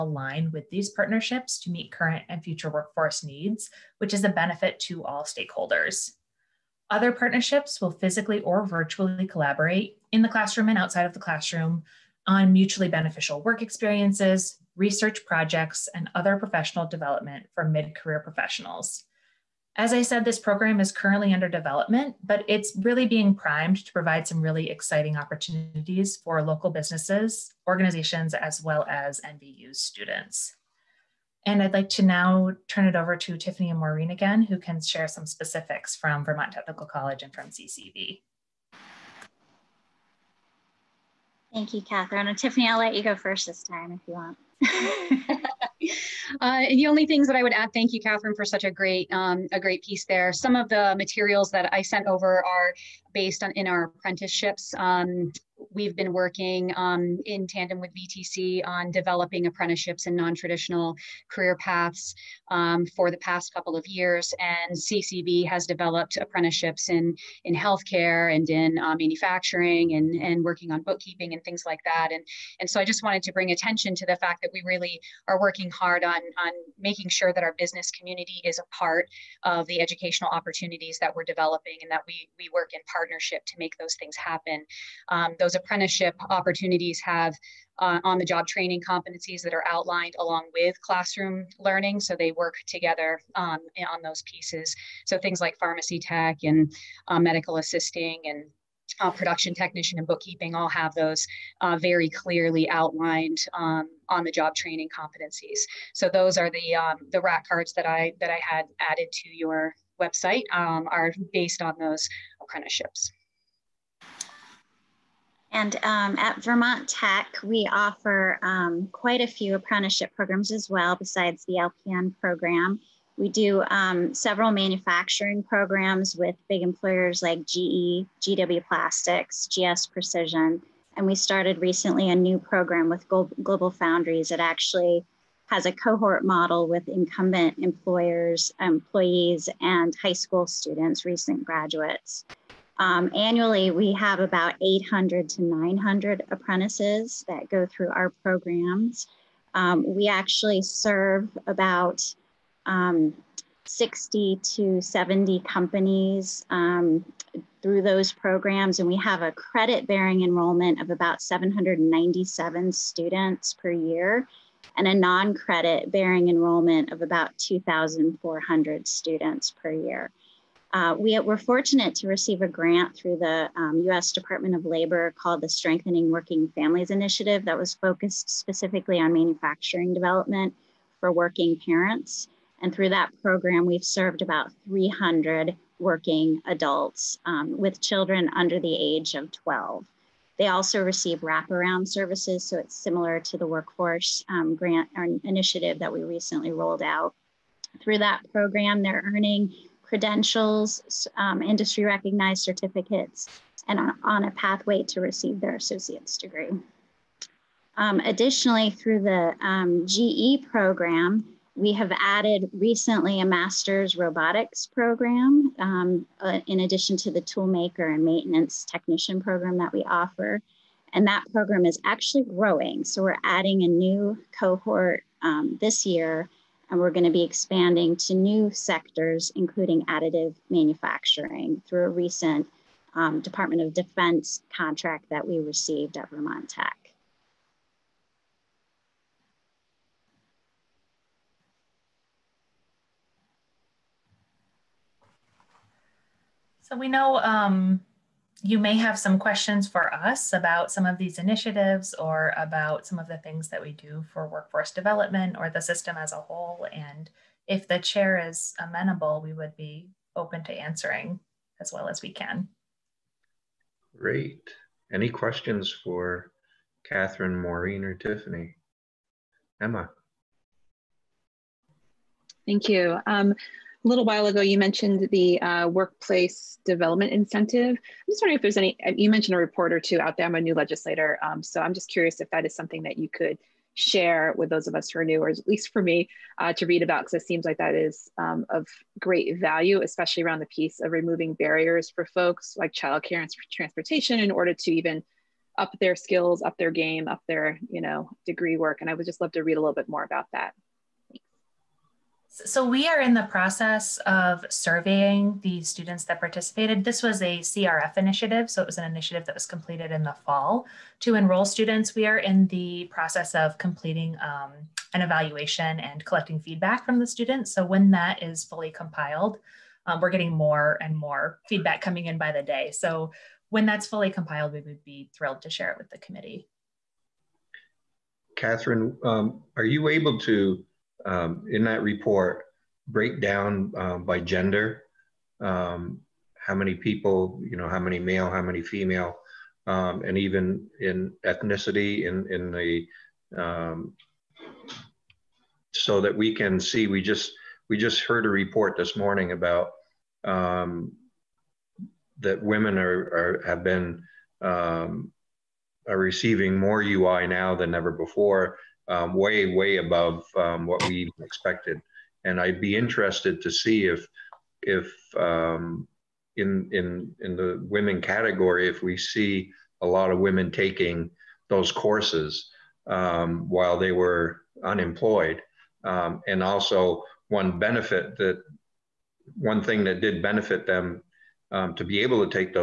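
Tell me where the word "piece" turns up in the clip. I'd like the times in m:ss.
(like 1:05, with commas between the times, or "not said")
0:49, 1:34, 4:50.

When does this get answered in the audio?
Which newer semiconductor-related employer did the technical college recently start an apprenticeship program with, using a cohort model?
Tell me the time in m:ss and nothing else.
2:13.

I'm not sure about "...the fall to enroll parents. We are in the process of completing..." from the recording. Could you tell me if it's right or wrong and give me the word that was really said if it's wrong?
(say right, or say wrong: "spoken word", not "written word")
wrong: "students", not "parents".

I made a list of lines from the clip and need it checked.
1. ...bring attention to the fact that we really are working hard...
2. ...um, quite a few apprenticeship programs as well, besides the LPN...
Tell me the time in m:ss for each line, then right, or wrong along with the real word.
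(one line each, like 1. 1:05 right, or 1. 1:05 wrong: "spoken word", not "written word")
1. 1:13 right
2. 1:58 right.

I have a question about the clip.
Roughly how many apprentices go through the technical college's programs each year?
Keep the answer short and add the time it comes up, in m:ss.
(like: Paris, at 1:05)
800 to 900, at 2:24.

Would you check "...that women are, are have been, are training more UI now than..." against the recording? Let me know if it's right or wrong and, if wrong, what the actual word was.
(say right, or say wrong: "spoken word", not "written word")
wrong: "receiving", not "training".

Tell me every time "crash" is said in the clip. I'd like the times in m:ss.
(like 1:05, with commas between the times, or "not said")
not said.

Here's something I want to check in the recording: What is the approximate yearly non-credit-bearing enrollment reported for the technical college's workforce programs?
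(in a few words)
2,400.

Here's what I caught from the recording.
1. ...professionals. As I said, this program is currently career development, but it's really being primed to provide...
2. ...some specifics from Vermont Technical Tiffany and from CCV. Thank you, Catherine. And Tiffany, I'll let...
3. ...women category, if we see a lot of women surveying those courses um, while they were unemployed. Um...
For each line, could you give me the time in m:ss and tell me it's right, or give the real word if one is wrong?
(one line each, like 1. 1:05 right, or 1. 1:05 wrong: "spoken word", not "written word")
1. 0:18 wrong: "under", not "career"
2. 0:35 wrong: "College", not "Tiffany"
3. 6:07 wrong: "taking", not "surveying".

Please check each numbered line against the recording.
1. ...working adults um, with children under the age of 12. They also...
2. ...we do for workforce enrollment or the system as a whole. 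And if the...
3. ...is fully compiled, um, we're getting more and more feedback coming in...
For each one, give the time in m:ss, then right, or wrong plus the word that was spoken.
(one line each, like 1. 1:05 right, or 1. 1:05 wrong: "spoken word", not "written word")
1. 3:05 right
2. 4:13 wrong: "development", not "enrollment"
3. 5:18 right.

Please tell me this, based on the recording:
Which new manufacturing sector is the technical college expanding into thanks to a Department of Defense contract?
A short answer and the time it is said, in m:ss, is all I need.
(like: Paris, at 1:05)
additive manufacturing, at 3:49.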